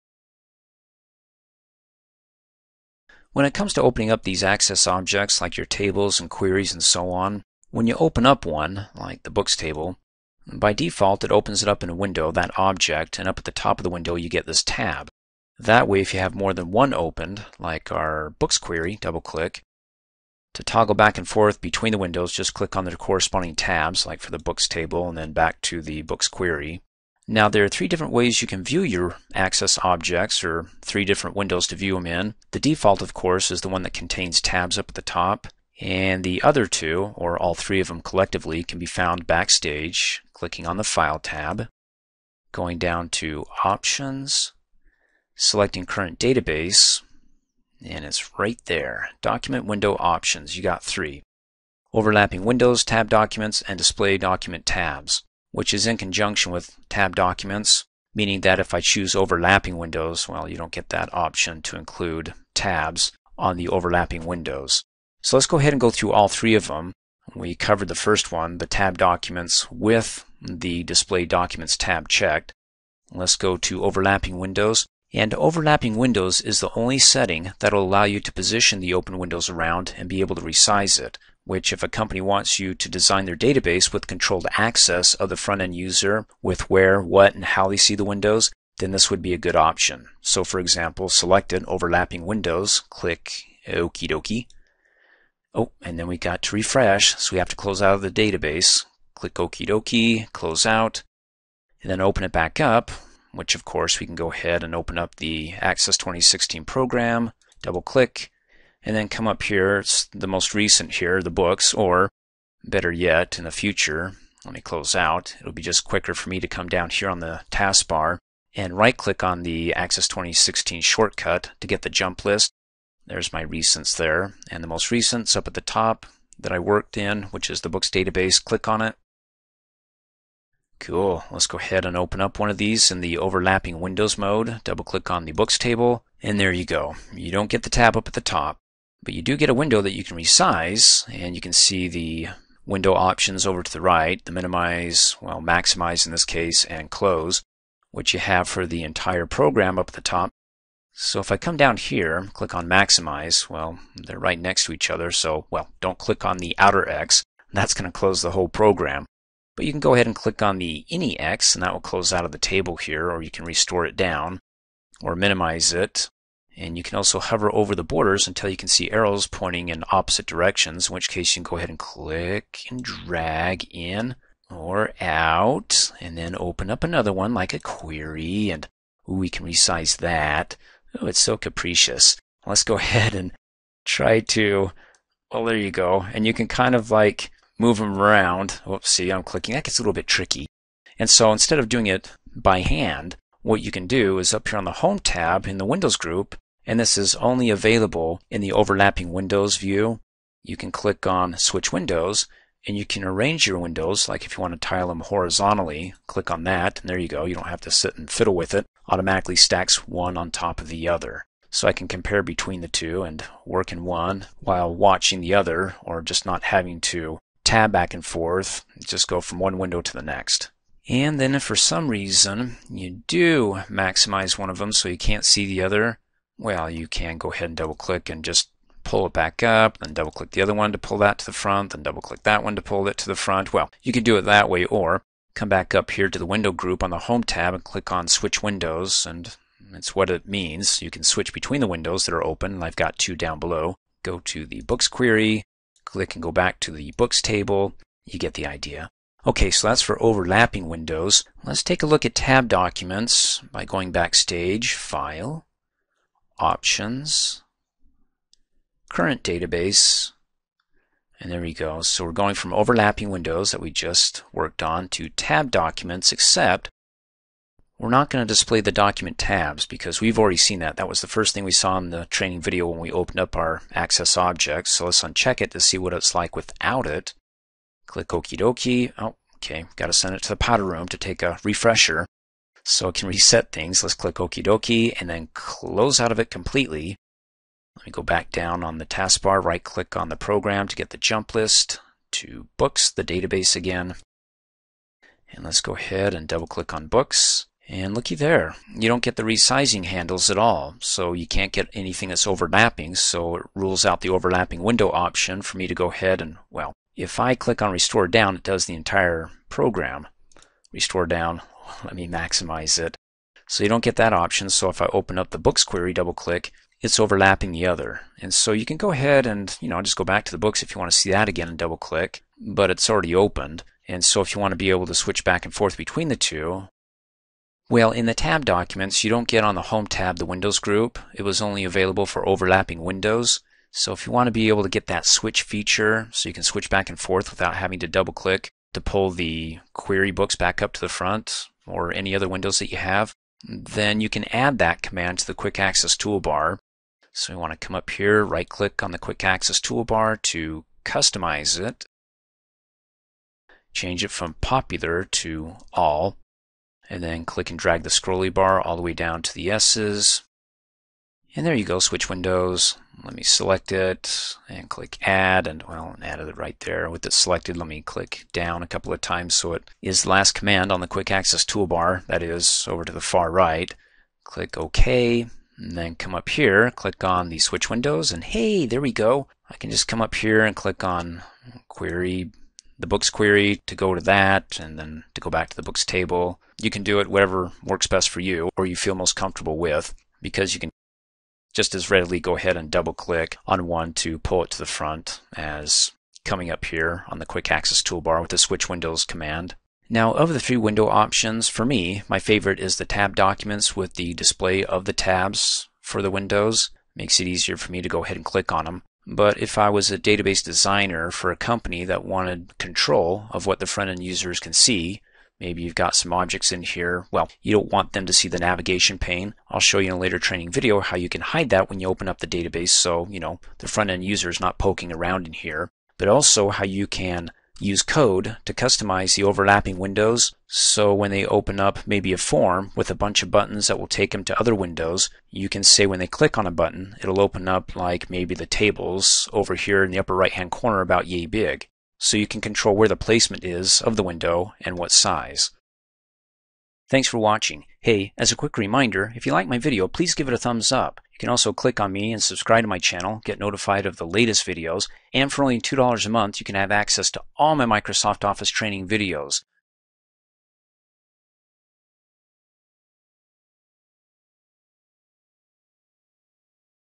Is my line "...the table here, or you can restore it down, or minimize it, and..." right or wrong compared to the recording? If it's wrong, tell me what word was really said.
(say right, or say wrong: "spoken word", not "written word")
right.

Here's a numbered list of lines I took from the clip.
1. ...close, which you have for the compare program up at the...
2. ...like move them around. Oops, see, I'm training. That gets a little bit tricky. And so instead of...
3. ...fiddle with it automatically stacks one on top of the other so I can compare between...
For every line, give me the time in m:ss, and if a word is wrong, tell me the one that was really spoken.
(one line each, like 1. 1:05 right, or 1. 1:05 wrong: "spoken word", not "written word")
1. 2:26 wrong: "entire", not "compare"
2. 3:06 wrong: "clicking", not "training"
3. 3:28 right.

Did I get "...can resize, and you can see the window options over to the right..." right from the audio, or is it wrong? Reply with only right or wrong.
right.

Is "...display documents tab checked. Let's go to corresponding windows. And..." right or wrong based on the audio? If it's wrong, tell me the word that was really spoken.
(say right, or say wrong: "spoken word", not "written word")
wrong: "overlapping", not "corresponding".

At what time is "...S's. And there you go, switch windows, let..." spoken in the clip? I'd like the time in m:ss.
5:59.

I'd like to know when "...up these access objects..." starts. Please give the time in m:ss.
0:04.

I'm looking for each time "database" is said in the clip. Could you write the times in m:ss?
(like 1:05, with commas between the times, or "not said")
0:46, 1:23, 1:38, 2:07, 4:19, 4:53, 6:49, 7:02.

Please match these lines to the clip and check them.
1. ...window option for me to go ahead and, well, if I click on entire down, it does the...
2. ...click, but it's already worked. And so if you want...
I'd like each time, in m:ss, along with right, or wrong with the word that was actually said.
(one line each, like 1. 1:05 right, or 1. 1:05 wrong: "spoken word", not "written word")
1. 5:04 wrong: "restore", not "entire"
2. 5:21 wrong: "opened", not "worked".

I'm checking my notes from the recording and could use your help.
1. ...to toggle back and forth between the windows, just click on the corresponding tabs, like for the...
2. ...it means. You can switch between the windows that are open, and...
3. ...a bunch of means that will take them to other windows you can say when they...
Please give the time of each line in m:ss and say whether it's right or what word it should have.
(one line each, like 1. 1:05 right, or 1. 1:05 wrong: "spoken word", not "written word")
1. 0:20 right
2. 4:00 right
3. 7:12 wrong: "buttons", not "means".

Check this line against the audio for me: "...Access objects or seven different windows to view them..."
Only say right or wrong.
wrong.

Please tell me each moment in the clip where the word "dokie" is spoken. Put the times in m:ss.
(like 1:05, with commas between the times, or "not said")
1:34, 1:39, 4:38, 4:44.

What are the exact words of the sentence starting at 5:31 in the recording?
It was only available for overlapping windows.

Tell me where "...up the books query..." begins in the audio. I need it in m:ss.
5:15.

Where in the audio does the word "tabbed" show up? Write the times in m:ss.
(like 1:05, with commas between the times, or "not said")
0:52, 0:56, 1:08, 4:12, 4:25, 5:28, 6:42.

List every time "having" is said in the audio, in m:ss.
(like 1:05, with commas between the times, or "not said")
3:36, 5:37.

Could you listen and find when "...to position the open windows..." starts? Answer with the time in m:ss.
1:18.